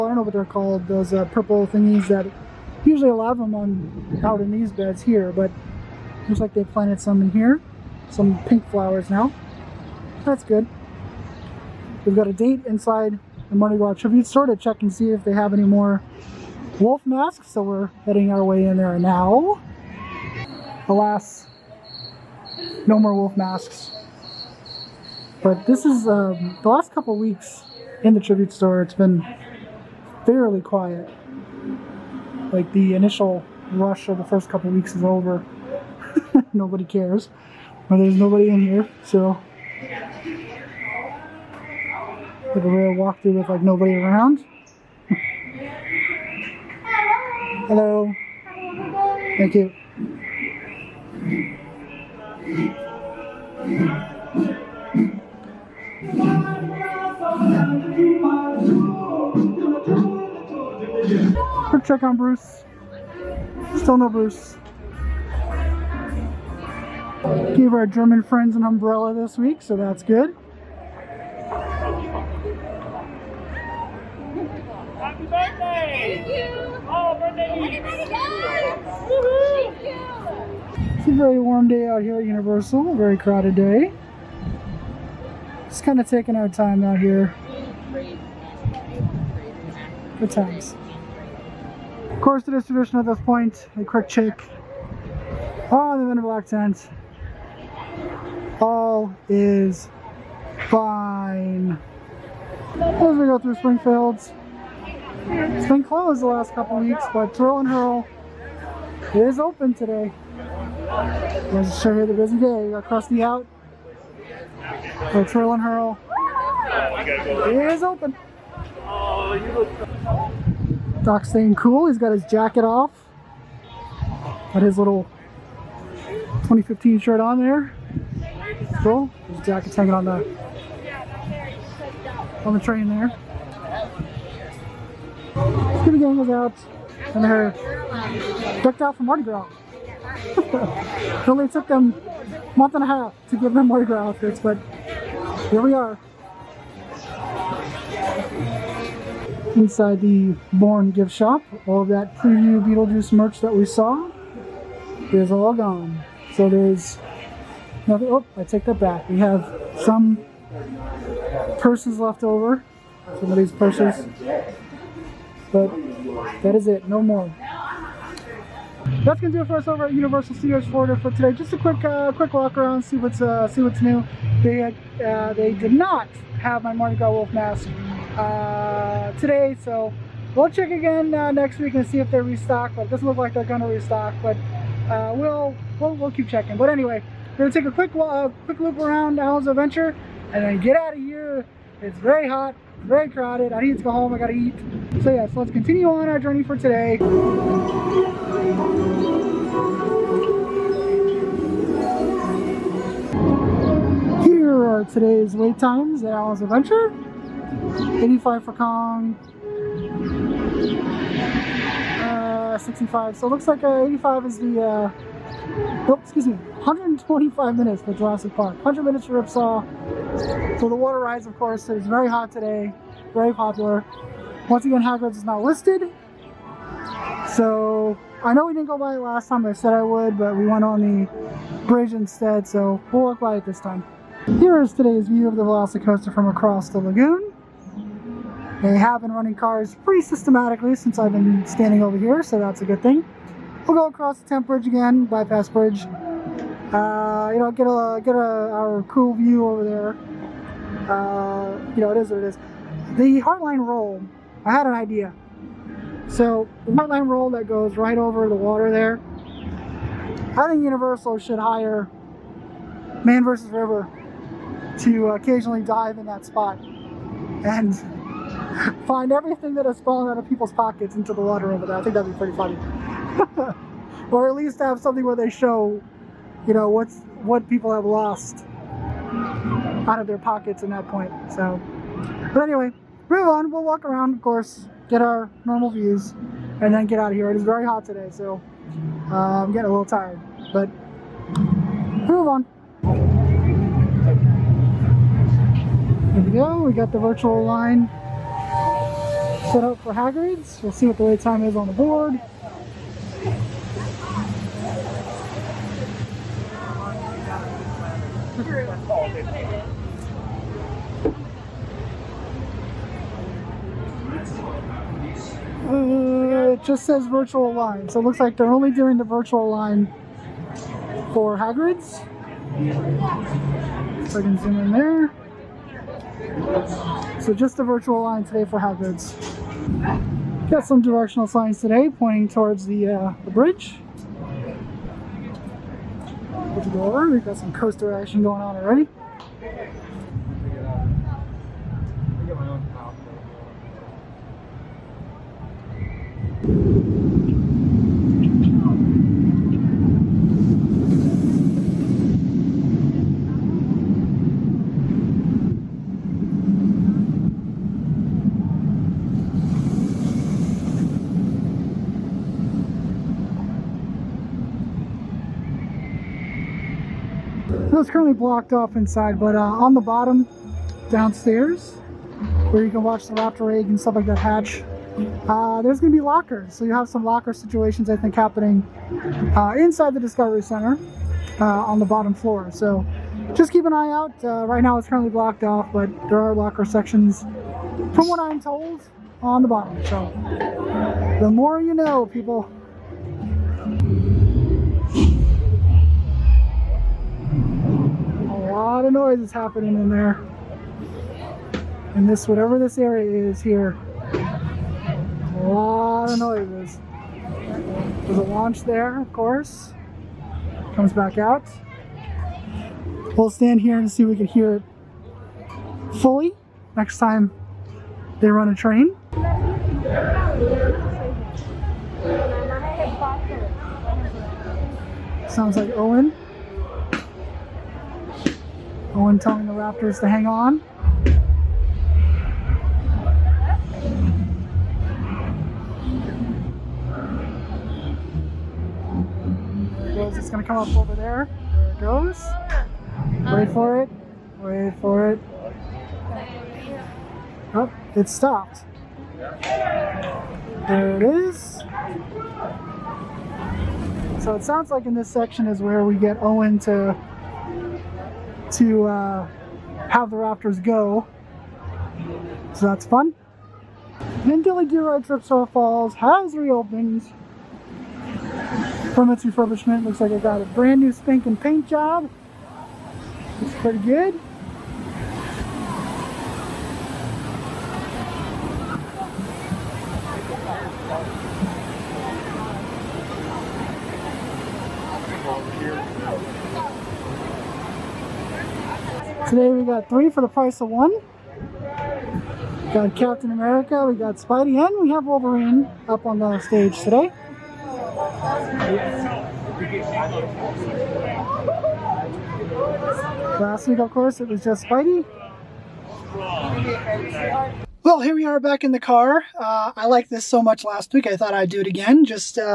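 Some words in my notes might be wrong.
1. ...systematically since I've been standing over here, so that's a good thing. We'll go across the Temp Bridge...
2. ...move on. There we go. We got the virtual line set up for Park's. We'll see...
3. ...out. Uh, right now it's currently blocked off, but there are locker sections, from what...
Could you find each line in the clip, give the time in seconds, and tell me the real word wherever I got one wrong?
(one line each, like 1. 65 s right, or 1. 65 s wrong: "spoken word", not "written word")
1. 240 s right
2. 292 s wrong: "Hagrid", not "Park"
3. 383 s right.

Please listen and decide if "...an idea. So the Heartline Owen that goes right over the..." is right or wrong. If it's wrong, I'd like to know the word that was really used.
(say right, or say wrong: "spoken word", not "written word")
wrong: "Roll", not "Owen".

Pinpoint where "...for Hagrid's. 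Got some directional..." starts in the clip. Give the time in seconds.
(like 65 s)
328 s.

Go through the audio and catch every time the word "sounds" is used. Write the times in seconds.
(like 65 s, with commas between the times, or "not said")
425 s, 454 s.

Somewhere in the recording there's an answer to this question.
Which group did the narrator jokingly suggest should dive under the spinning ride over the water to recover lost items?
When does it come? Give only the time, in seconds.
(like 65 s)
263 s.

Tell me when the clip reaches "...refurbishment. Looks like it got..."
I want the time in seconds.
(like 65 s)
469 s.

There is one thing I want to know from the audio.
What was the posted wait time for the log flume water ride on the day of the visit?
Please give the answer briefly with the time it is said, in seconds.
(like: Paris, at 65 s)
100 minutes, at 218 s.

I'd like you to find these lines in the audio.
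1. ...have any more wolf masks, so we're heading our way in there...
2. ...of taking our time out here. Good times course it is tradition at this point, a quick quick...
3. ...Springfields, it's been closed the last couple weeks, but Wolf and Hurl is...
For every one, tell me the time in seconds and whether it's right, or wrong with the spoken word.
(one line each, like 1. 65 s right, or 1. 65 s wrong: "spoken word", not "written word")
1. 15 s right
2. 86 s wrong: "check", not "quick"
3. 103 s wrong: "Twirl", not "Wolf".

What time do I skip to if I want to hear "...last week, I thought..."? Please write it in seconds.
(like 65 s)
510 s.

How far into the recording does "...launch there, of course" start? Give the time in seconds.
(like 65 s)
408 s.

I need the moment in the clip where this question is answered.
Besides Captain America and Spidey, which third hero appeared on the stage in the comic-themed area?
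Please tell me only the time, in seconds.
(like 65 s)
495 s.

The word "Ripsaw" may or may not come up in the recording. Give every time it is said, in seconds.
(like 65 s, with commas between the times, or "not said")
219 s, 465 s.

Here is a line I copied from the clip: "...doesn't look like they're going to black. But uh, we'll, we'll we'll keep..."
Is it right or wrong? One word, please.
wrong.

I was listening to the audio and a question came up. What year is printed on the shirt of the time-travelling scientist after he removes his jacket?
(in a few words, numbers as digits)
2015.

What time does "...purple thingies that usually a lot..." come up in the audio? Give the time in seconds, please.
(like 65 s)
1 s.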